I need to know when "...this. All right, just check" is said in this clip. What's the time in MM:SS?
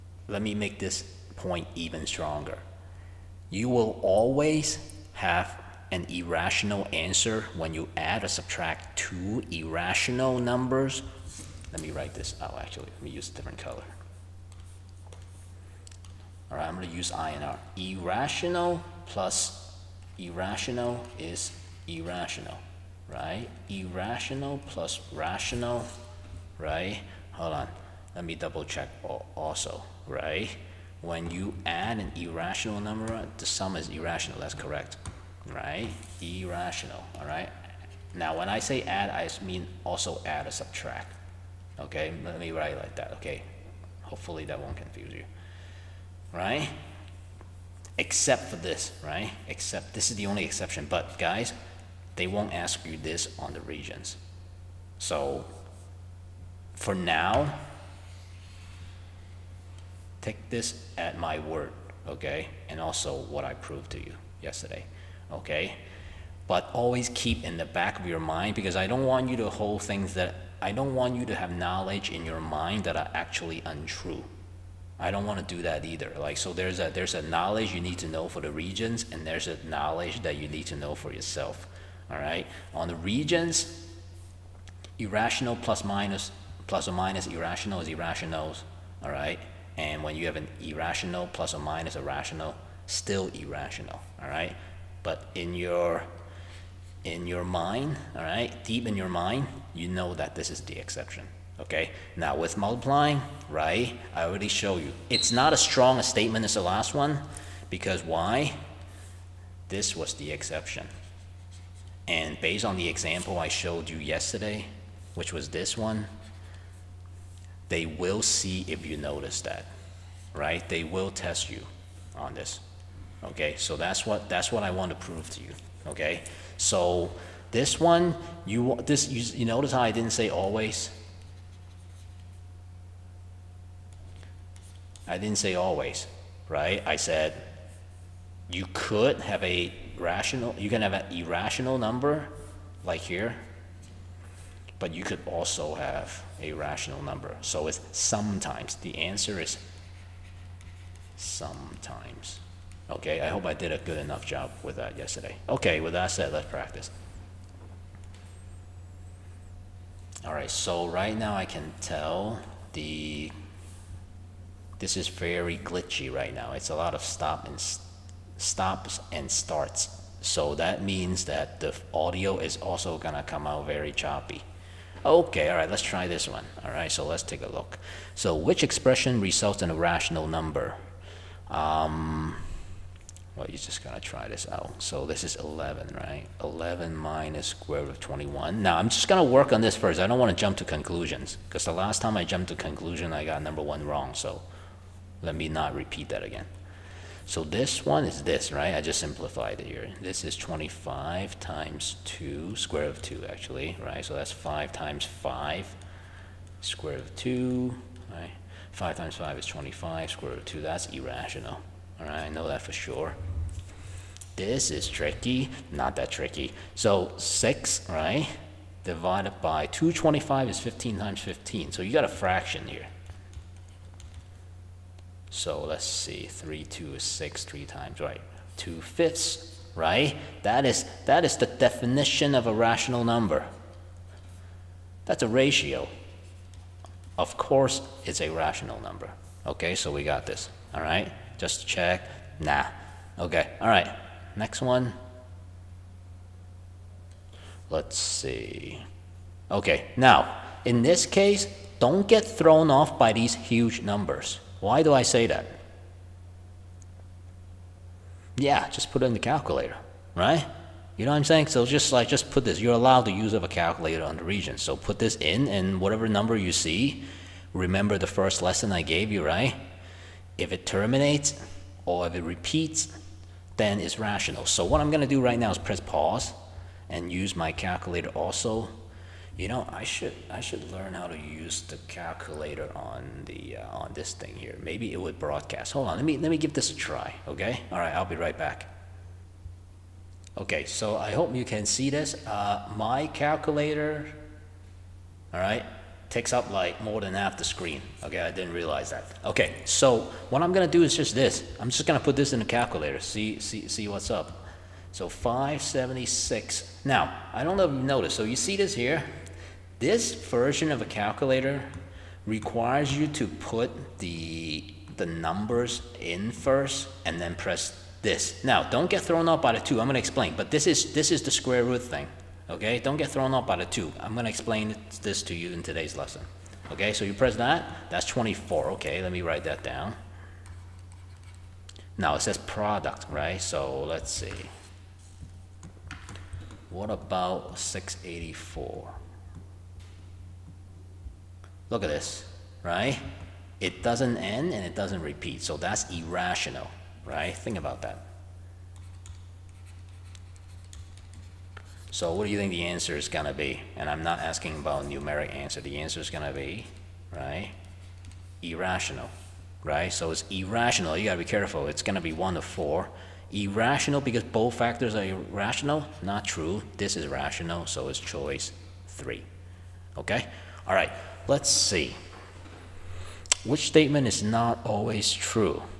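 04:00.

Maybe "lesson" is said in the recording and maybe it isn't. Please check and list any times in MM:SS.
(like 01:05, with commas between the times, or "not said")
04:28, 05:25.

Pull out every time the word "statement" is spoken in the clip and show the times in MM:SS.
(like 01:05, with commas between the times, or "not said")
01:46, 06:13.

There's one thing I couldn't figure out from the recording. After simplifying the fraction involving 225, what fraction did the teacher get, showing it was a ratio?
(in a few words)
2 fifths.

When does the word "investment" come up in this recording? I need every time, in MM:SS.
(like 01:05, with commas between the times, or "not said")
not said.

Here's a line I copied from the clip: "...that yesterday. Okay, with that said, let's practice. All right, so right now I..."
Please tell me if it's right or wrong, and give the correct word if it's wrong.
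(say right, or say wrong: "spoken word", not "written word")
right.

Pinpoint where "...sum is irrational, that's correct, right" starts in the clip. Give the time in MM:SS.
00:33.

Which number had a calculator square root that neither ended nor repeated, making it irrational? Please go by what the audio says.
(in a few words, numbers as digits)
684.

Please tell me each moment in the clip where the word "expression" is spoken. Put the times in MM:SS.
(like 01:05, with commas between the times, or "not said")
02:58.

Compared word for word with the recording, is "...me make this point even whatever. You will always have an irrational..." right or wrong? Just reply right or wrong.
wrong.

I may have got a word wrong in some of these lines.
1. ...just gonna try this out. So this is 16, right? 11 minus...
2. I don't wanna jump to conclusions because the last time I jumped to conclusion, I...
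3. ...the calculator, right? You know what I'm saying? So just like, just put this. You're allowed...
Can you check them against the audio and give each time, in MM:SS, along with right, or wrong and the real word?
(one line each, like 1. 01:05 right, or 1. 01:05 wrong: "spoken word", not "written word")
1. 03:03 wrong: "11", not "16"
2. 03:09 right
3. 04:19 right.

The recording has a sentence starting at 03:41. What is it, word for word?
So you got a fraction here.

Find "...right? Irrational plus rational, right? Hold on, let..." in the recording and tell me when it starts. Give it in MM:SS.
00:23.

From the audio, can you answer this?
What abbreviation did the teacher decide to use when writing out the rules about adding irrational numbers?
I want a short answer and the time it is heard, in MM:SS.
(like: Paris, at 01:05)
INR, at 00:17.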